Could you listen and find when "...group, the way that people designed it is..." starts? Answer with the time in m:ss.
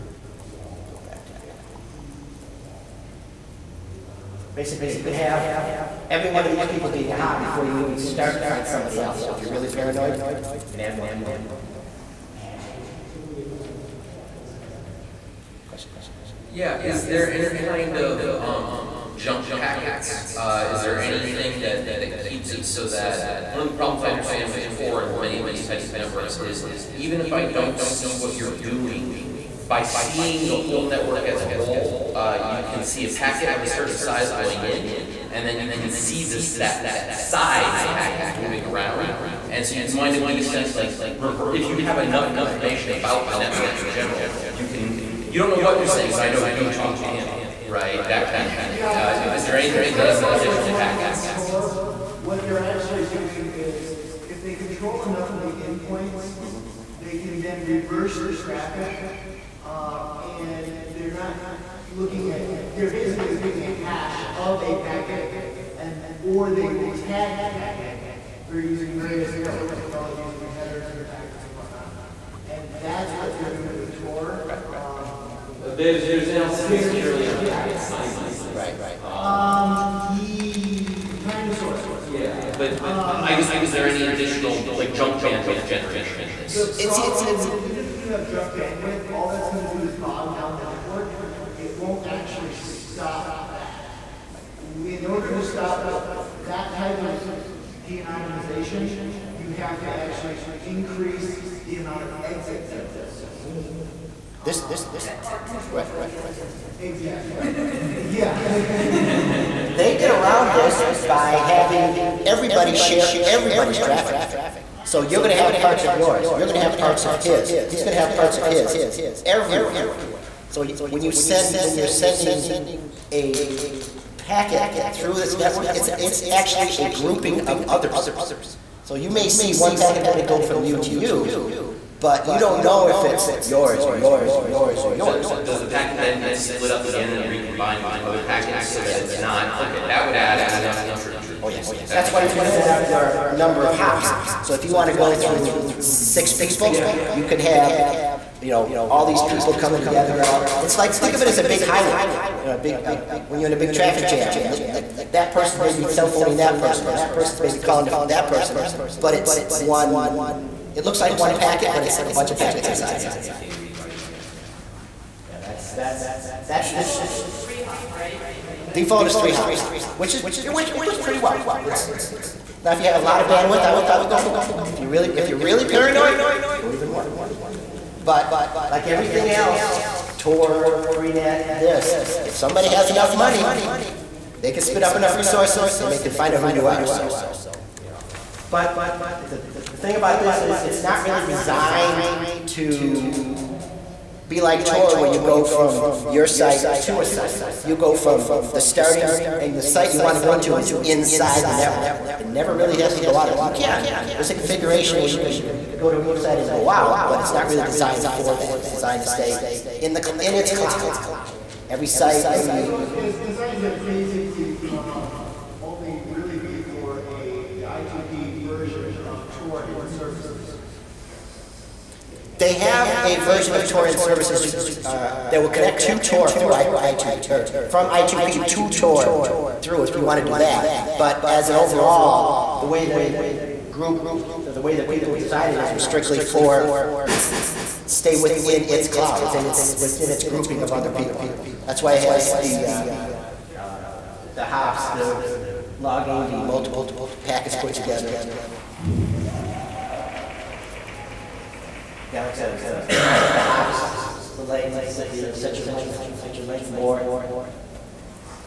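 3:53.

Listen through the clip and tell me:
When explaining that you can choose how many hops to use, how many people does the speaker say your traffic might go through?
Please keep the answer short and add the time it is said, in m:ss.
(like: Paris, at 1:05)
6, at 2:25.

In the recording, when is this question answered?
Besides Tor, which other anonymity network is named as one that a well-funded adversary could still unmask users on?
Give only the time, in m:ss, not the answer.
3:00.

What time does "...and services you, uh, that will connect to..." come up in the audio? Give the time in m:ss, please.
3:43.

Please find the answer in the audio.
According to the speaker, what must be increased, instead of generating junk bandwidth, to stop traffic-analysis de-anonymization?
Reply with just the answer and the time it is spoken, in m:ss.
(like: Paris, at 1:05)
exit nodes, at 1:42.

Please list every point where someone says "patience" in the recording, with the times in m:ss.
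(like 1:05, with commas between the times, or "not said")
not said.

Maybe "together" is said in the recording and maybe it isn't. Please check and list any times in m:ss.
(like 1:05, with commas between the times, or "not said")
2:29, 4:07.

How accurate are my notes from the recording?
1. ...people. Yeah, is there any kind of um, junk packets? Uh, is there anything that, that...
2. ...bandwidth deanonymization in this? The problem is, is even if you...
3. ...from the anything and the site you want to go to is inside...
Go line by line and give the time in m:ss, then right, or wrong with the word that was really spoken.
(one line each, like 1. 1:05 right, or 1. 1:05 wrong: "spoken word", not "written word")
1. 0:11 right
2. 1:25 wrong: "generation", not "deanonymization"
3. 3:17 wrong: "starting", not "anything".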